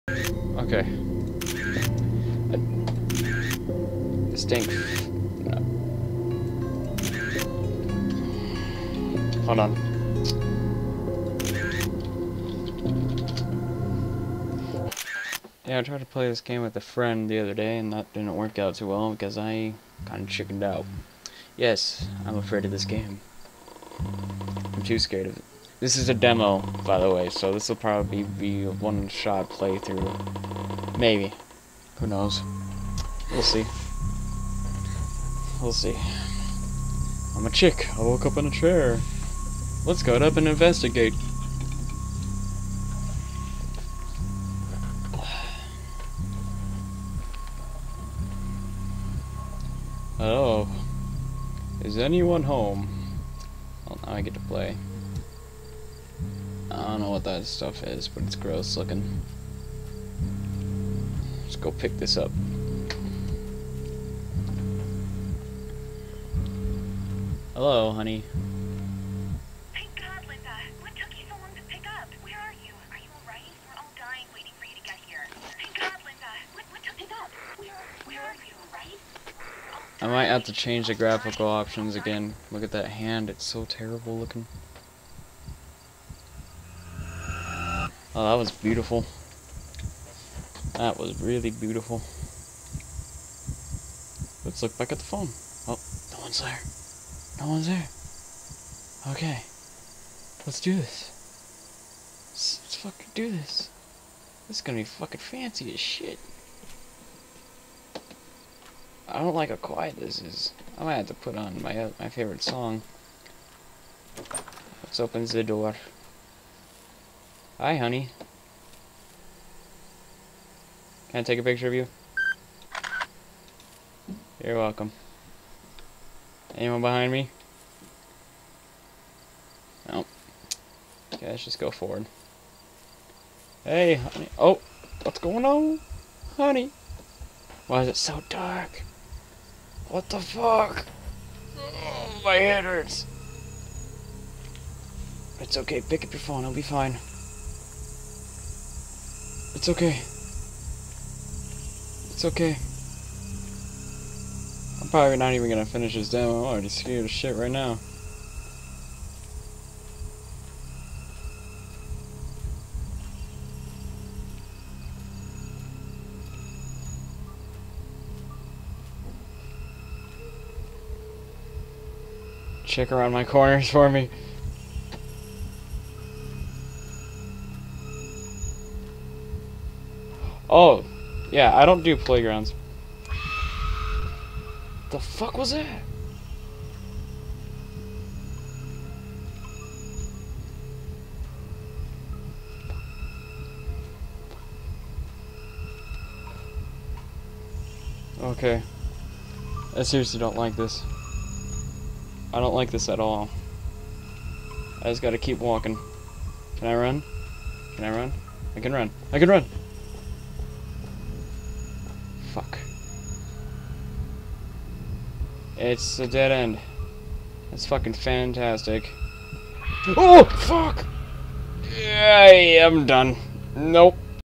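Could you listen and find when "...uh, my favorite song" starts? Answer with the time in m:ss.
1:51.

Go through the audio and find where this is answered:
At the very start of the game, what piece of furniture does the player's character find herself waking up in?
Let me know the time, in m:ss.
0:38.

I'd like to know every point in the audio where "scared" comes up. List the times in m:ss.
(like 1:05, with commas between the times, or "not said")
0:24, 2:36.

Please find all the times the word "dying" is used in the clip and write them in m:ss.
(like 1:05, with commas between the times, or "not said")
1:13.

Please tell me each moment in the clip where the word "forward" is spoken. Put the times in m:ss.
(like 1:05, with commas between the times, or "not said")
2:11.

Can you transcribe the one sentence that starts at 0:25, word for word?
This is a demo, by the way, so this will probably be a one-shot playthrough.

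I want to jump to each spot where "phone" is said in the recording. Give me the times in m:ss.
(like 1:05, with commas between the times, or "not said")
1:35, 2:26.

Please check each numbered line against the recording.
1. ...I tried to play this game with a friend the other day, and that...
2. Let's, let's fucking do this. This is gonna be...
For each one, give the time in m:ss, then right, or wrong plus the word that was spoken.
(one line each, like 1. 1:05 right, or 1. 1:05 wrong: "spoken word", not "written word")
1. 0:15 right
2. 1:42 right.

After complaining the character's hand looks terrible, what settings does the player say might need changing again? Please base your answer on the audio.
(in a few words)
graphical options.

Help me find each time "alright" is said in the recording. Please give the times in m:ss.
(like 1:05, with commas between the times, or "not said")
1:13.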